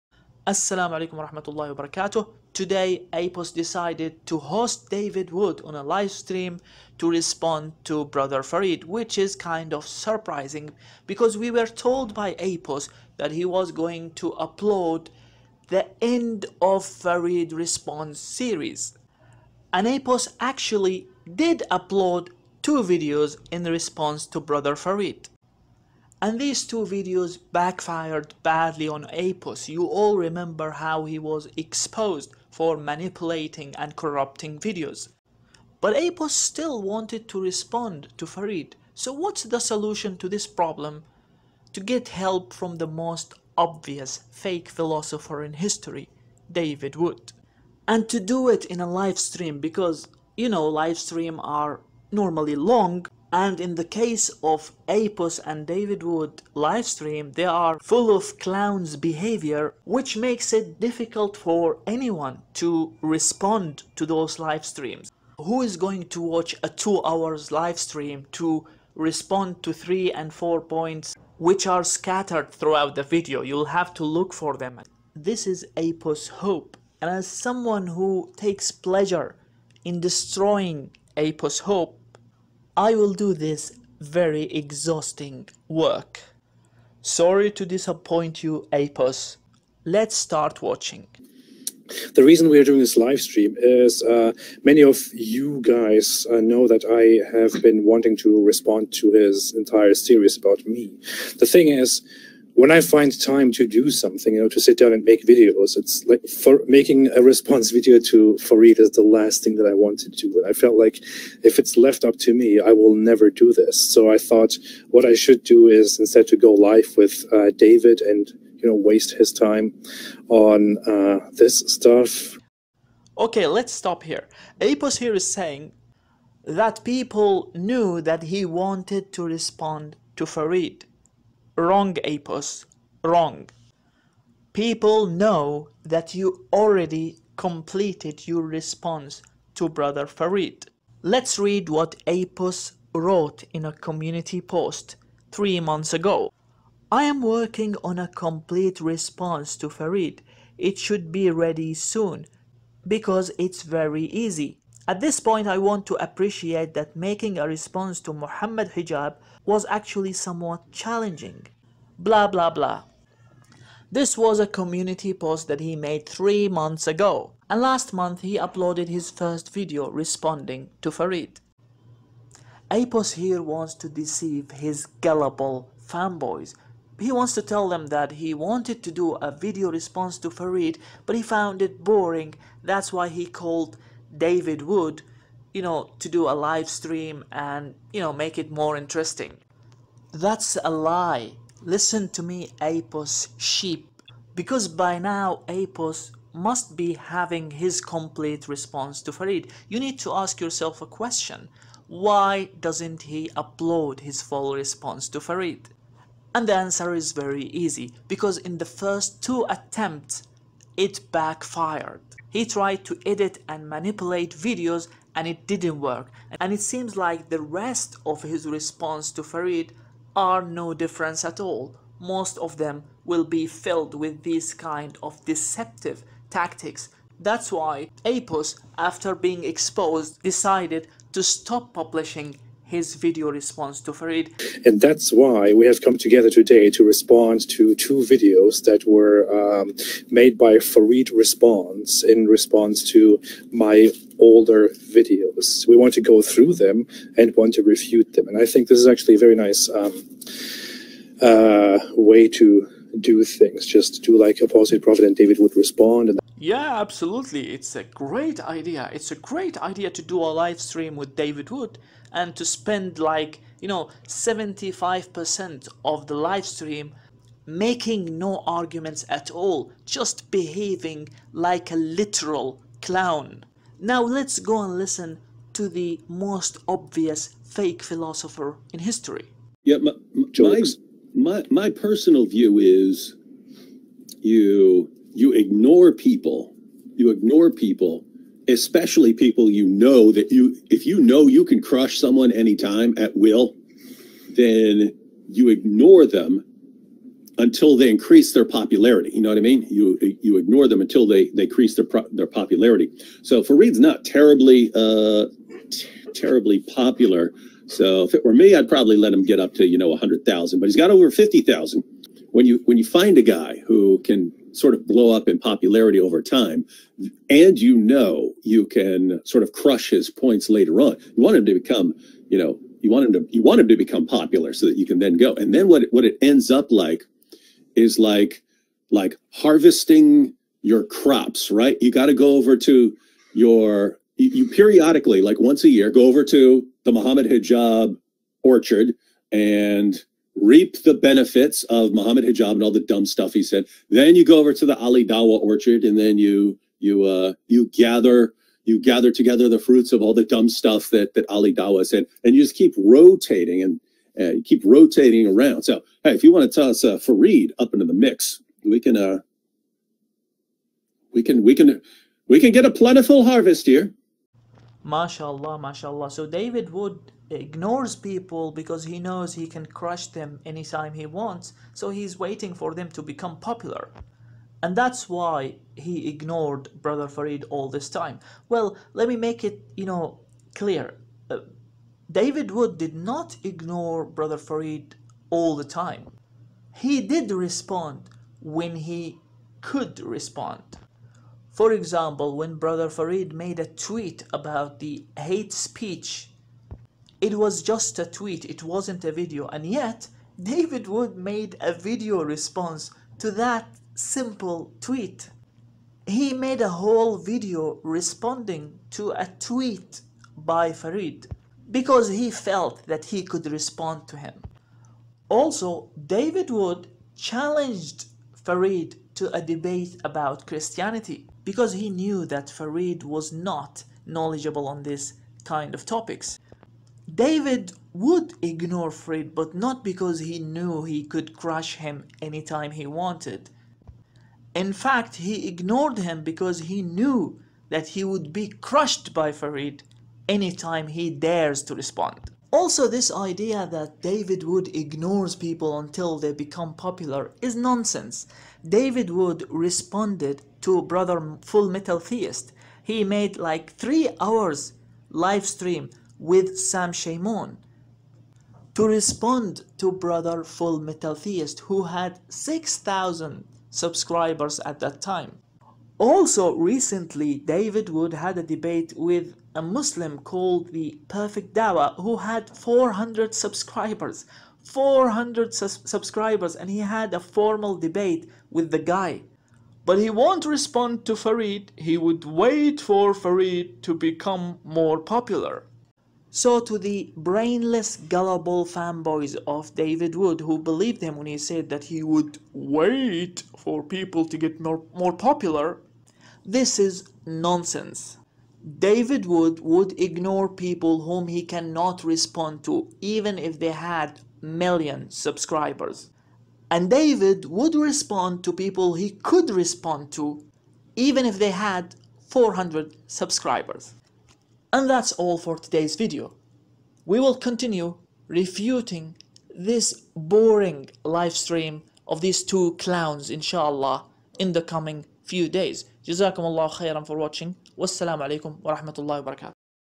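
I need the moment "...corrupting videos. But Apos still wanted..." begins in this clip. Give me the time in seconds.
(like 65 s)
33 s.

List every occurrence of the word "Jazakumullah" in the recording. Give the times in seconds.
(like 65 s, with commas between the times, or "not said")
526 s.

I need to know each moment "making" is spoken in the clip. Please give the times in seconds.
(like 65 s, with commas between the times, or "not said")
106 s, 156 s, 267 s.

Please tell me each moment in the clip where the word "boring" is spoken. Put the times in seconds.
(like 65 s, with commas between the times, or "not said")
181 s, 520 s.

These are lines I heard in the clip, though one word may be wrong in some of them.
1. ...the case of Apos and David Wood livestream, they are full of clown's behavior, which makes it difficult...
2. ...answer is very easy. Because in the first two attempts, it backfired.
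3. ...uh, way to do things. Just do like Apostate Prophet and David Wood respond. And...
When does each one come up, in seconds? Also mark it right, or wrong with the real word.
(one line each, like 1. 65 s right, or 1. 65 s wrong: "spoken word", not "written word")
1. 53 s right
2. 206 s right
3. 251 s right.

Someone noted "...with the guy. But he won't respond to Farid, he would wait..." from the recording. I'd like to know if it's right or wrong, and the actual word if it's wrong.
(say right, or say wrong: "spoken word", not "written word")
right.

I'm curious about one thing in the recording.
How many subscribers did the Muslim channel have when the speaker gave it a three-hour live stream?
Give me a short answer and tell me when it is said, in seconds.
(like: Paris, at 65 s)
6,000, at 462 s.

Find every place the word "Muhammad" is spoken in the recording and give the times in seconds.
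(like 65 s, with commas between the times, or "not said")
158 s, 336 s, 341 s.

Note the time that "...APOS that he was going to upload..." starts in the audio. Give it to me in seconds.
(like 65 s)
12 s.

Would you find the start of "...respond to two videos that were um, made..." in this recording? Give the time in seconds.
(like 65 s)
236 s.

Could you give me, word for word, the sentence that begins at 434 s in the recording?
In fact, he ignored him because he knew that he would be crushed by Farid anytime he dares to respond.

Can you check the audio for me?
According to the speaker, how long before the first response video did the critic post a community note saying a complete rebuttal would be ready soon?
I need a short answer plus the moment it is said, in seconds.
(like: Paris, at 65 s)
3 months, at 166 s.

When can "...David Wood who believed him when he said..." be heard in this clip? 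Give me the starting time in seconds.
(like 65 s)
489 s.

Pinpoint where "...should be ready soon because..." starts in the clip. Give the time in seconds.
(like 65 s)
150 s.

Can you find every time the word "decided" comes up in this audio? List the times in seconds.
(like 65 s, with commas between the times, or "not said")
3 s, 230 s.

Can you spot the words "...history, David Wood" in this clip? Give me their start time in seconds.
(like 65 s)
45 s.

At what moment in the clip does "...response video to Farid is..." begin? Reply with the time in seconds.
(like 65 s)
107 s.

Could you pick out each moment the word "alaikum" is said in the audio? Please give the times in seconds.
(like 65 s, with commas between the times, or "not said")
0 s, 528 s.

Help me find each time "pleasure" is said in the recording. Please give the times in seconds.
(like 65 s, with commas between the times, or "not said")
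78 s.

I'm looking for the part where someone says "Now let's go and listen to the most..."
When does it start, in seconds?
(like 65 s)
273 s.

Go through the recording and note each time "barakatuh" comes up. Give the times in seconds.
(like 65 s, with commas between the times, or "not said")
1 s, 529 s.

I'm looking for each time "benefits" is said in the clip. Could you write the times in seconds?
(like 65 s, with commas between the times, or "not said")
340 s.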